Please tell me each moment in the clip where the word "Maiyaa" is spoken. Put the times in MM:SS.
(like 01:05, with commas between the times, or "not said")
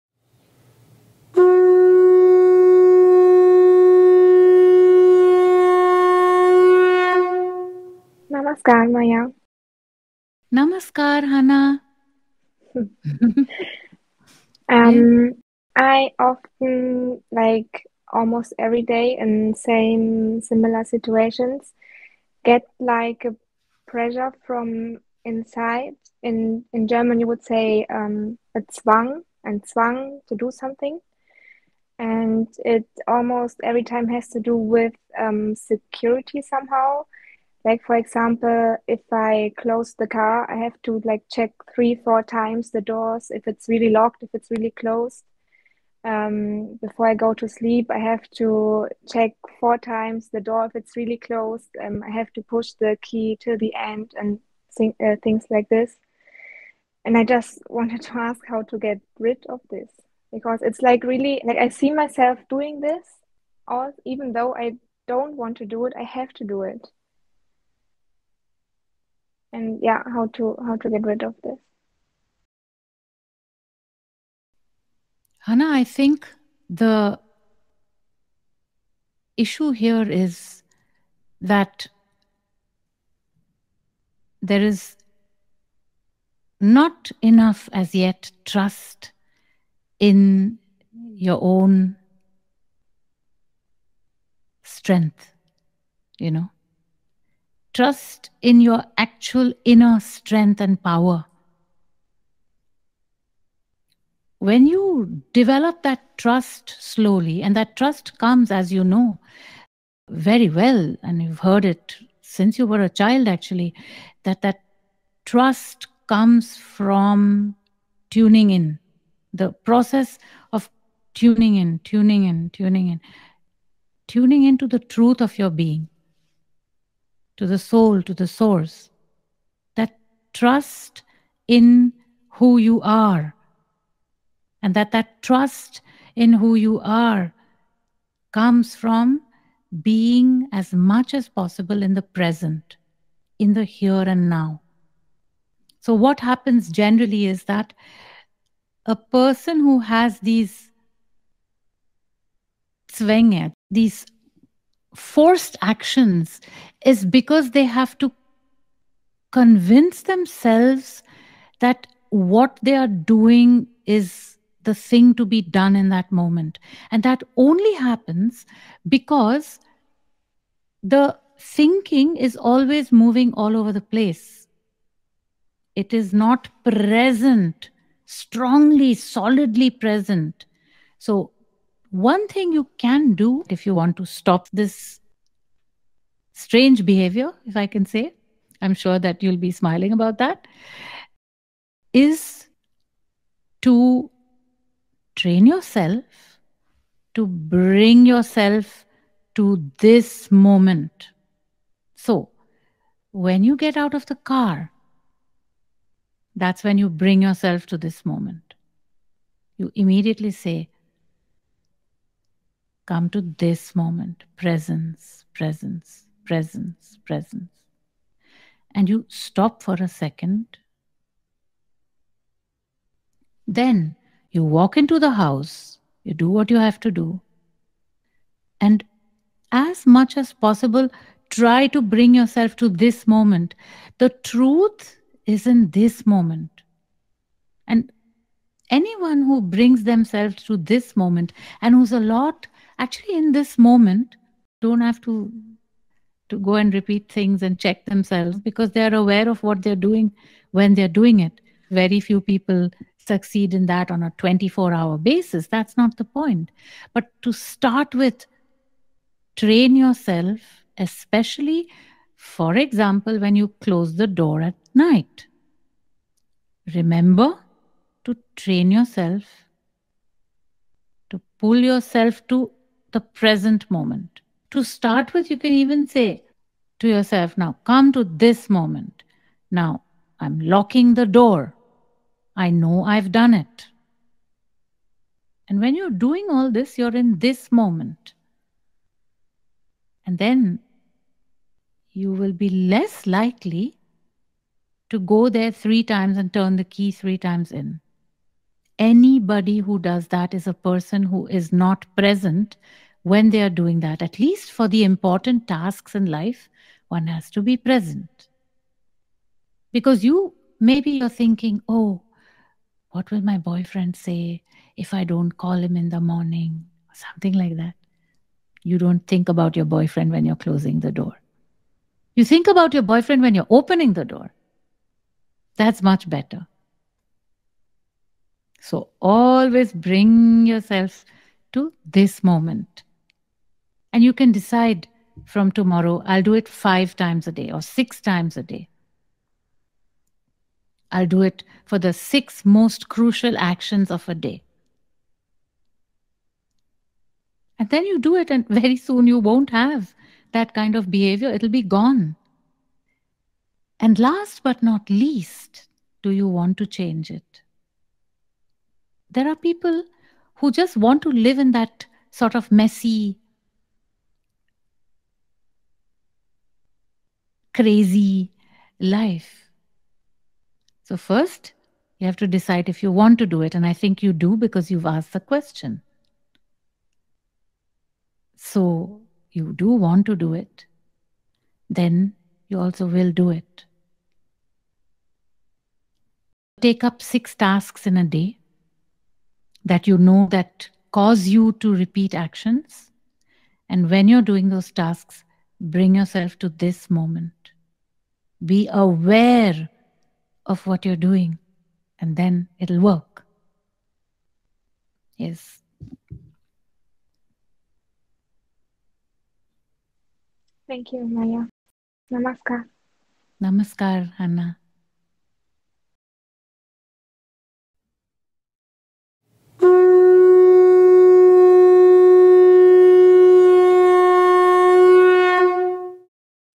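00:08, 06:51.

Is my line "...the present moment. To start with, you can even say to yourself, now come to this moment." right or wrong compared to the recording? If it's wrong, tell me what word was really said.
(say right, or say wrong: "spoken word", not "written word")
right.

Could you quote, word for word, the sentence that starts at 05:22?
You think about your boyfriend when you're opening the door.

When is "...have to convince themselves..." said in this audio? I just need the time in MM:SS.
02:37.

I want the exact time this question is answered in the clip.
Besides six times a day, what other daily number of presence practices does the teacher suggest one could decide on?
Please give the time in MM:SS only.
05:36.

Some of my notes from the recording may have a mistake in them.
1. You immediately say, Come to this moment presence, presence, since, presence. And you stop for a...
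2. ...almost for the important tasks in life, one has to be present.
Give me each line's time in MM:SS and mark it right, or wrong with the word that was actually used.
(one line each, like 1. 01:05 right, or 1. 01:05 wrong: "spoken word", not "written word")
1. 03:29 wrong: "presence", not "since"
2. 05:04 wrong: "least", not "almost".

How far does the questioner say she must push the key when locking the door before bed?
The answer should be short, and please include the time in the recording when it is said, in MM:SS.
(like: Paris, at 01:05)
till the end, at 00:53.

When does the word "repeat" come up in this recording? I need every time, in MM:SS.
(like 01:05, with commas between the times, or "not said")
04:06, 06:31.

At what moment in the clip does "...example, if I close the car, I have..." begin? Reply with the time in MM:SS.
00:37.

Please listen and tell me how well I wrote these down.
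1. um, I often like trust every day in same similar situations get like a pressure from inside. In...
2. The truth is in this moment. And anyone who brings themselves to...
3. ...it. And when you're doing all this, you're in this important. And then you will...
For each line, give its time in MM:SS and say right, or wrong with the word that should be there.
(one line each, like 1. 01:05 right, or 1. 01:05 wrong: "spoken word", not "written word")
1. 00:14 wrong: "almost", not "trust"
2. 03:53 right
3. 04:43 wrong: "moment", not "important".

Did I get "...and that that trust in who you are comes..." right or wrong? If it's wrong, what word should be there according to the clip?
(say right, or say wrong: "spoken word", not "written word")
right.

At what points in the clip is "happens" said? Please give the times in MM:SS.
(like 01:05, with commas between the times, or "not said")
02:26, 02:47.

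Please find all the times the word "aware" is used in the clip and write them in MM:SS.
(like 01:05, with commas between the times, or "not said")
04:08, 06:38.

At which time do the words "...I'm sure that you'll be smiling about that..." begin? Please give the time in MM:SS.
03:08.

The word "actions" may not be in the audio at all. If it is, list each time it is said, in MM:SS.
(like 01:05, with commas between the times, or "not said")
02:35, 05:43, 06:32.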